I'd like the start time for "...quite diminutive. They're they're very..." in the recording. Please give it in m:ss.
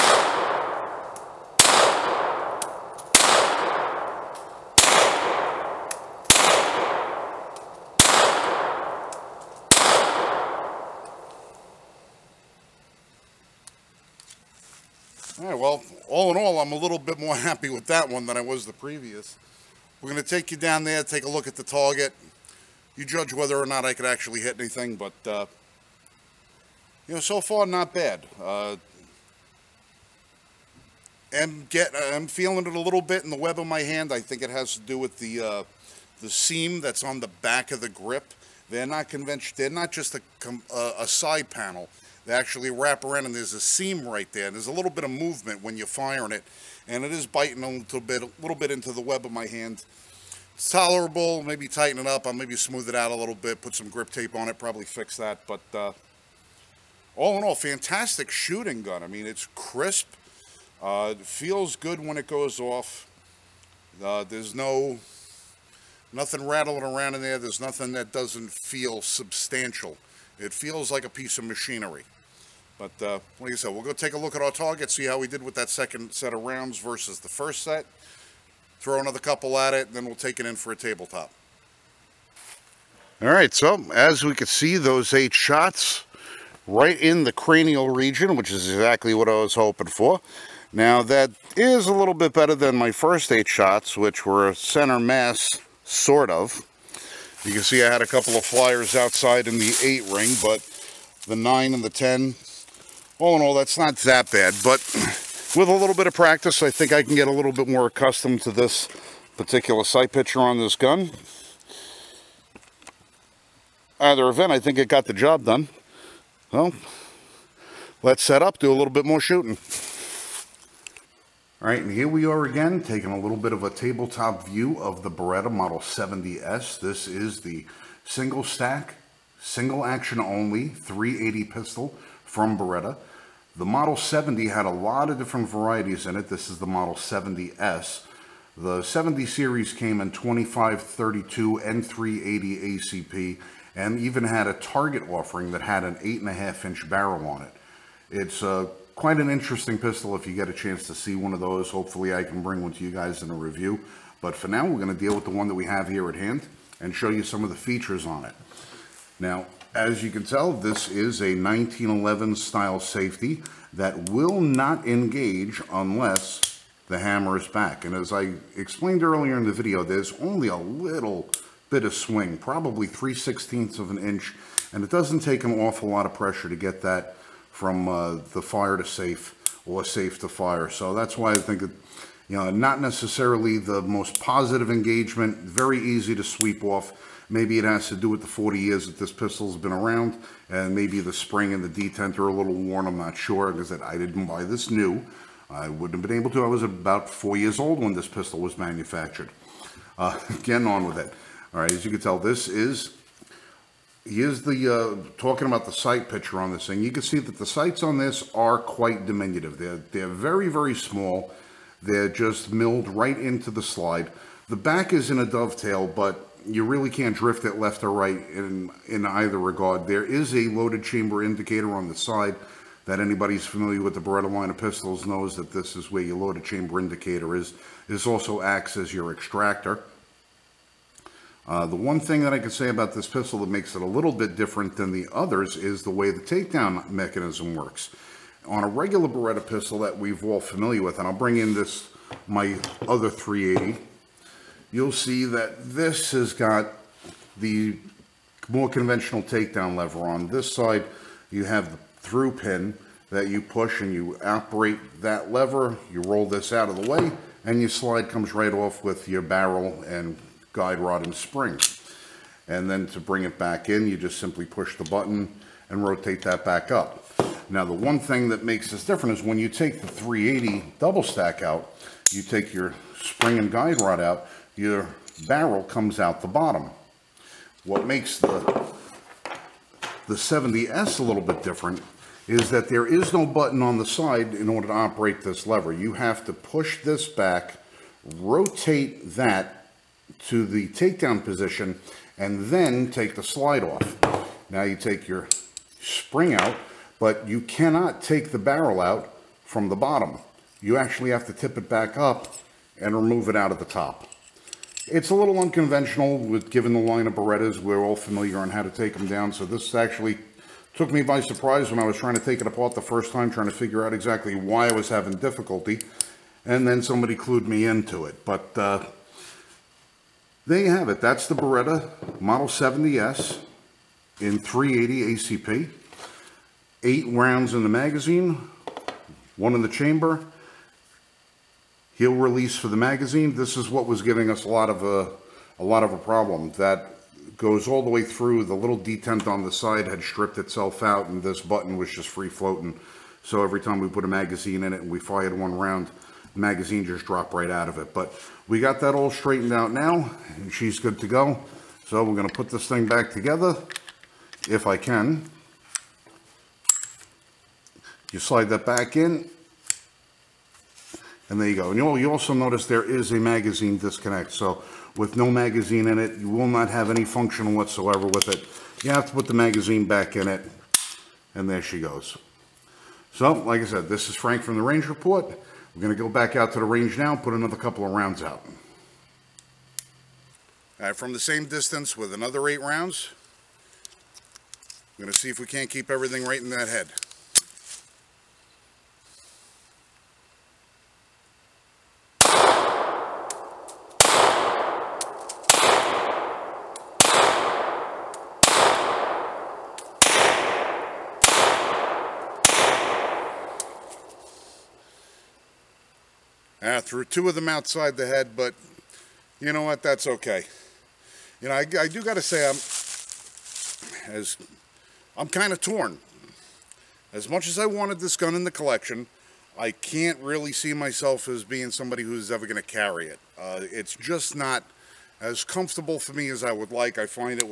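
3:28.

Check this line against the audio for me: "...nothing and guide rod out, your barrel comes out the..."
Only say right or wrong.
wrong.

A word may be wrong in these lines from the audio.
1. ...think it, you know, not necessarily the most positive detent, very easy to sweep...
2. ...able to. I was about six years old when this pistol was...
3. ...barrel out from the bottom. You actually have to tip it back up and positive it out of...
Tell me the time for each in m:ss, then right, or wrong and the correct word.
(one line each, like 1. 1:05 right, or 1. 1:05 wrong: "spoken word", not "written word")
1. 3:01 wrong: "engagement", not "detent"
2. 3:16 wrong: "four", not "six"
3. 4:58 wrong: "remove", not "positive".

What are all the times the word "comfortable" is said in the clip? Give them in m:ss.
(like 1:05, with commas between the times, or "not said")
7:05.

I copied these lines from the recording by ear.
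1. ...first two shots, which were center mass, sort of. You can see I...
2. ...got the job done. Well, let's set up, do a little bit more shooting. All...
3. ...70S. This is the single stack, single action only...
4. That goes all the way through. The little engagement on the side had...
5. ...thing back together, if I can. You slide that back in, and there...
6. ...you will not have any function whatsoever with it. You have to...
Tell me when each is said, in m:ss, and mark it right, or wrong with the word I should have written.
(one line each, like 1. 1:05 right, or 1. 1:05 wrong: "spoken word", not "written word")
1. 1:32 wrong: "eight", not "two"
2. 1:54 right
3. 2:05 right
4. 5:36 wrong: "detent", not "engagement"
5. 5:52 right
6. 6:06 right.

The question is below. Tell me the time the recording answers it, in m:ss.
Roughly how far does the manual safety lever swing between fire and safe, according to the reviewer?
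2:52.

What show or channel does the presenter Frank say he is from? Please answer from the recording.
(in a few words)
The Range Report.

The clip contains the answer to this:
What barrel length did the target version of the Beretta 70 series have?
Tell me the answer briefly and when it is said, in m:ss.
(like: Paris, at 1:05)
8.5 inches, at 2:25.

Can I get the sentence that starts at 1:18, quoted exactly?
Throw another couple at it, and then we'll take it in for a tabletop.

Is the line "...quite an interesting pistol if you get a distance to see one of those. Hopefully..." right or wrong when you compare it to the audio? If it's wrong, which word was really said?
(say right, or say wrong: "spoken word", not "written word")
wrong: "chance", not "distance".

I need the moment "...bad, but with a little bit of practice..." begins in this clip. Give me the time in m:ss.
1:44.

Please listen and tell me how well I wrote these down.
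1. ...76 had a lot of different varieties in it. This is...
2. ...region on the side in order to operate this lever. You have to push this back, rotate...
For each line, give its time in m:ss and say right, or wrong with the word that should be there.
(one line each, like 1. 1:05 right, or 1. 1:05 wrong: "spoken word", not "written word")
1. 2:13 wrong: "70", not "76"
2. 4:43 wrong: "button", not "region".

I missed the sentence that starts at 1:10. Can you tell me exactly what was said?
It feels like a piece of machinery.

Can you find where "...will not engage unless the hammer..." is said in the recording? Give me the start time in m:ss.
2:44.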